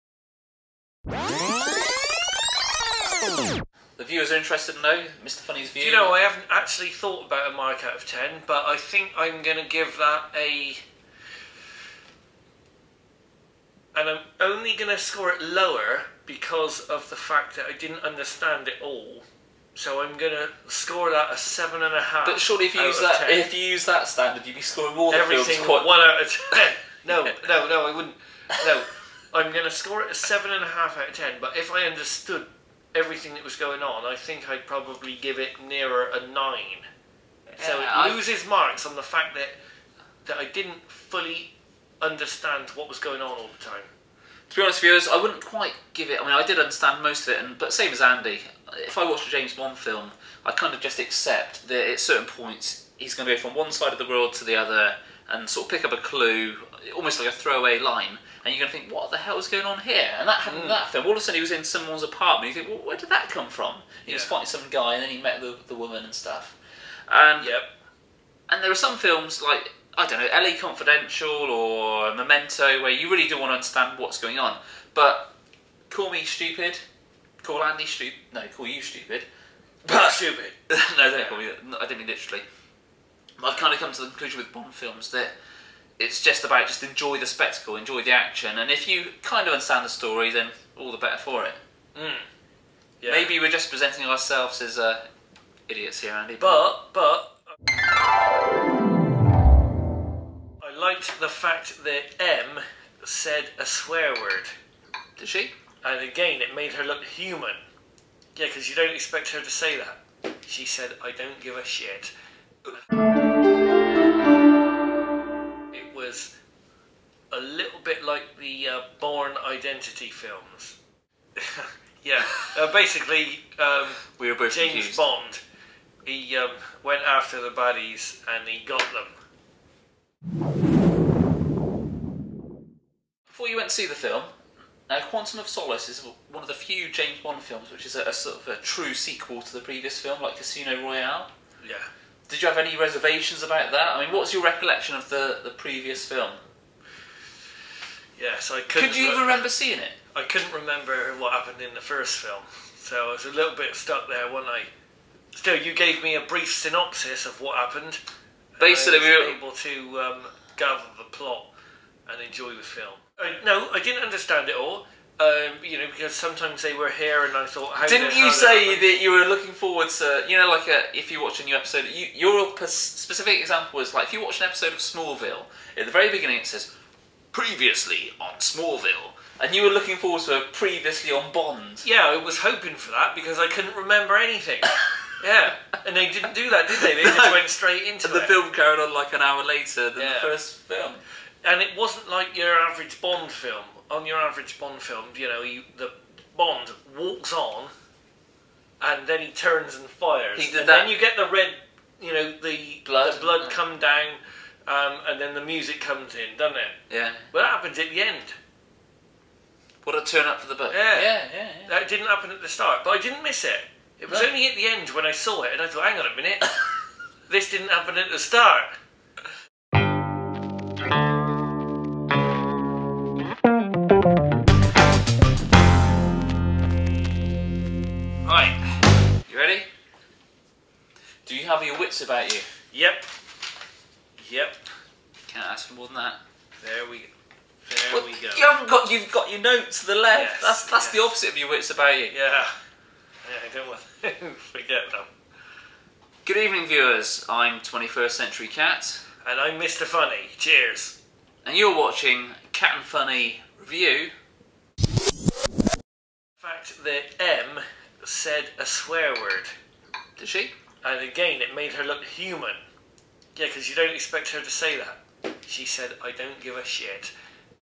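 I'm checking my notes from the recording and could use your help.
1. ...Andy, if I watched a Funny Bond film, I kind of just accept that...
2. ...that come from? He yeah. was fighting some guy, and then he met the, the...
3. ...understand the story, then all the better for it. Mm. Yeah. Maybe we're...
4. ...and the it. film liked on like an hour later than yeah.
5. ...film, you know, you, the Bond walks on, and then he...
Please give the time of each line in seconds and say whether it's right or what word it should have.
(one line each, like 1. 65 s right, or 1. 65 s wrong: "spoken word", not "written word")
1. 48 s wrong: "James", not "Funny"
2. 63 s right
3. 89 s right
4. 188 s wrong: "carried", not "liked"
5. 194 s right.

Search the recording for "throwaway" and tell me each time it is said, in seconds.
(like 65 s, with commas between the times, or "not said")
57 s.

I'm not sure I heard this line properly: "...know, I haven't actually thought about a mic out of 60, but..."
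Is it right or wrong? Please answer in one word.
wrong.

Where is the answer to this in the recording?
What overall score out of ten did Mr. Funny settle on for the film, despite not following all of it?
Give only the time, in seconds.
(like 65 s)
30 s.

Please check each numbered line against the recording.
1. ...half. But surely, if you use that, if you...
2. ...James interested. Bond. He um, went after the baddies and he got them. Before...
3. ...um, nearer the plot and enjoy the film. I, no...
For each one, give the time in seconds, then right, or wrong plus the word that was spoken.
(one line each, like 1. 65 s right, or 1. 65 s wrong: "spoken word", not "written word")
1. 22 s right
2. 124 s wrong: "confused", not "interested"
3. 159 s wrong: "gather", not "nearer".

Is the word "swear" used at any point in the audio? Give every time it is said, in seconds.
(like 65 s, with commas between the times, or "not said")
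103 s, 258 s.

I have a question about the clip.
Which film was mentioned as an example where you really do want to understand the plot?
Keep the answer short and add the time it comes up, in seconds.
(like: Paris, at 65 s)
LA Confidential or Memento, at 70 s.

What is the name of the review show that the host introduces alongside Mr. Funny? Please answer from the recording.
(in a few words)
21st Century Cat.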